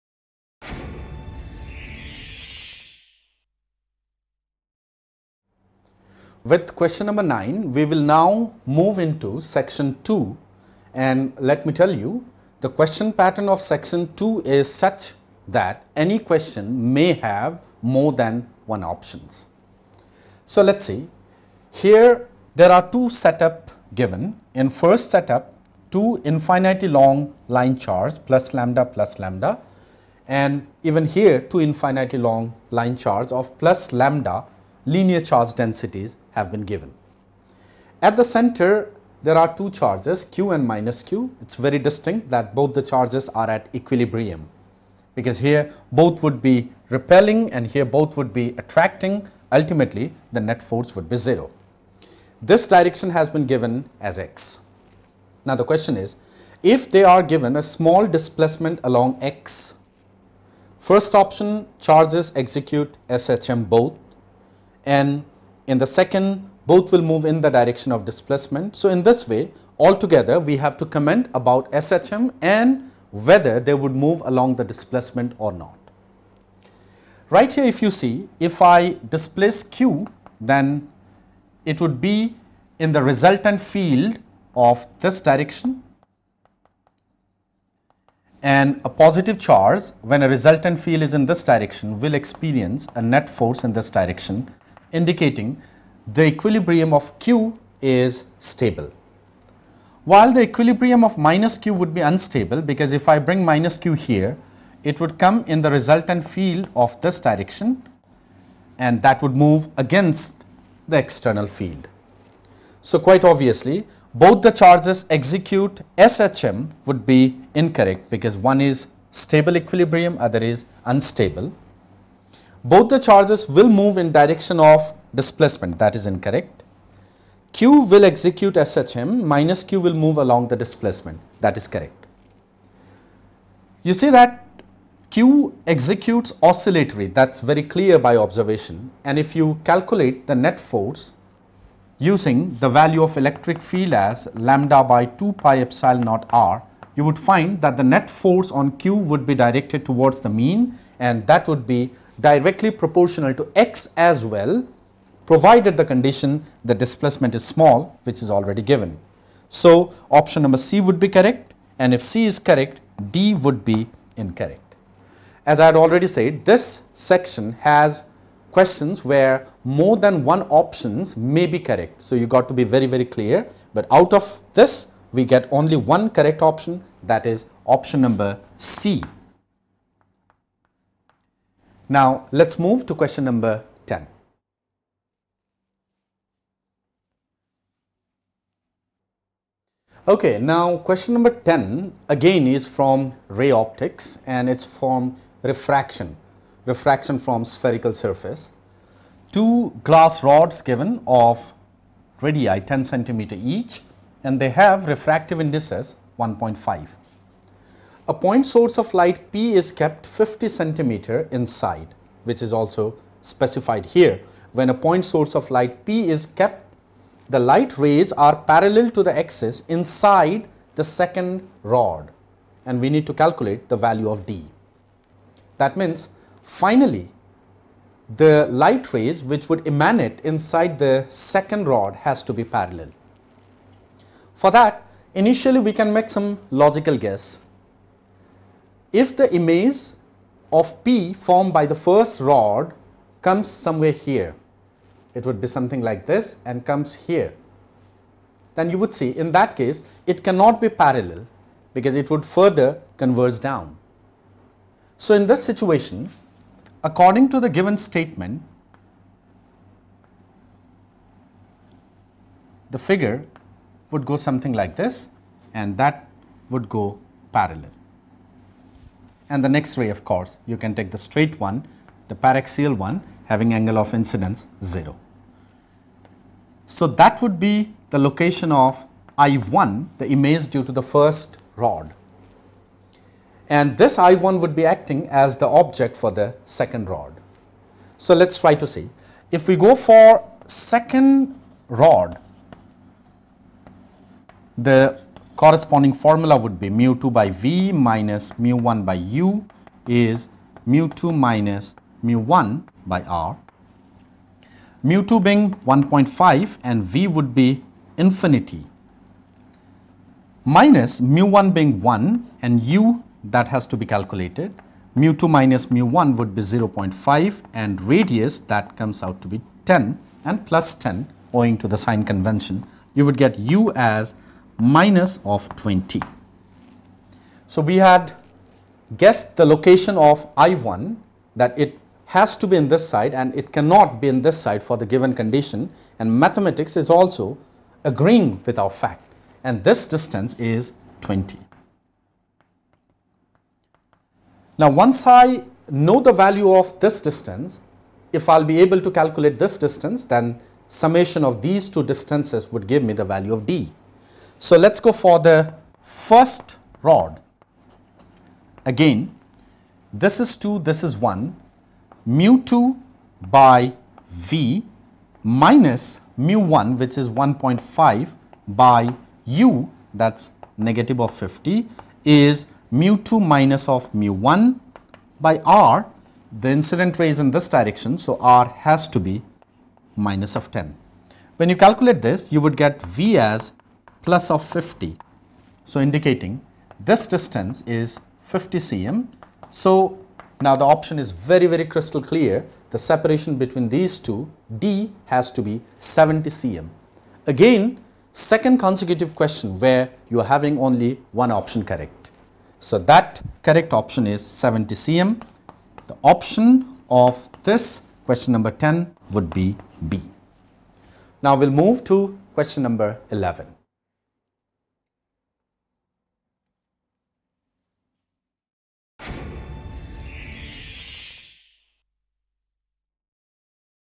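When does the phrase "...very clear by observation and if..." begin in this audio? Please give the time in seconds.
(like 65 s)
137 s.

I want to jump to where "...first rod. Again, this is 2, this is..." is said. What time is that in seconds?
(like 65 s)
355 s.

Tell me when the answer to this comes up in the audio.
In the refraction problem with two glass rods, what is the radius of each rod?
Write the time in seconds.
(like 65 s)
202 s.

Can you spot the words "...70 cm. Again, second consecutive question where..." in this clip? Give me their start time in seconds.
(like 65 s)
395 s.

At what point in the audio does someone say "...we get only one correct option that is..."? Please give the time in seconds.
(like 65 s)
175 s.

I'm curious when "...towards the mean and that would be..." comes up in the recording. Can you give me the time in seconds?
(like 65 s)
149 s.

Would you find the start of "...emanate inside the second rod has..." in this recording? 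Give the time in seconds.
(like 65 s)
229 s.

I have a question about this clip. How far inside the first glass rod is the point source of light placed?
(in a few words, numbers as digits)
50 cm.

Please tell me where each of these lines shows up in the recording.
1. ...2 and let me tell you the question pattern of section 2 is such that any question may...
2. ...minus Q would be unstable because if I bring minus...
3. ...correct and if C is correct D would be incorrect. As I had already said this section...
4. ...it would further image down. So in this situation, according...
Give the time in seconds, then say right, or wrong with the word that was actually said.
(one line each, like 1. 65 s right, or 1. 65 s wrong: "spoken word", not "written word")
1. 10 s right
2. 101 s right
3. 161 s right
4. 251 s wrong: "converge", not "image".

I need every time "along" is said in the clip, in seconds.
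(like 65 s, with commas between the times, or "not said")
58 s, 74 s, 130 s.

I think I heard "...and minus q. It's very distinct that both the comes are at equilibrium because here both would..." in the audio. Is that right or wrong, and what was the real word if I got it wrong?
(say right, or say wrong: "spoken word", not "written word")
wrong: "charges", not "comes".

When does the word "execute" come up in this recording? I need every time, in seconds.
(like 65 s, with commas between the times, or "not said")
62 s, 115 s, 128 s, 135 s.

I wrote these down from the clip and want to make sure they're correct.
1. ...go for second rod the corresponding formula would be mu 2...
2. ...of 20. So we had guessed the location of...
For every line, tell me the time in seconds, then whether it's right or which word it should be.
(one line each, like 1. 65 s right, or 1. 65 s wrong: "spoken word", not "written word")
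1. 289 s right
2. 325 s right.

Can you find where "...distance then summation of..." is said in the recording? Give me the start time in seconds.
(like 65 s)
349 s.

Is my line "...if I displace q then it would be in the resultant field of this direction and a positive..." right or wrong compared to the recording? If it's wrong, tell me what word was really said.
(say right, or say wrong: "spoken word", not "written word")
right.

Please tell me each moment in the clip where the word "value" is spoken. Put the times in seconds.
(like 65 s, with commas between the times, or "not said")
142 s, 223 s, 346 s, 353 s.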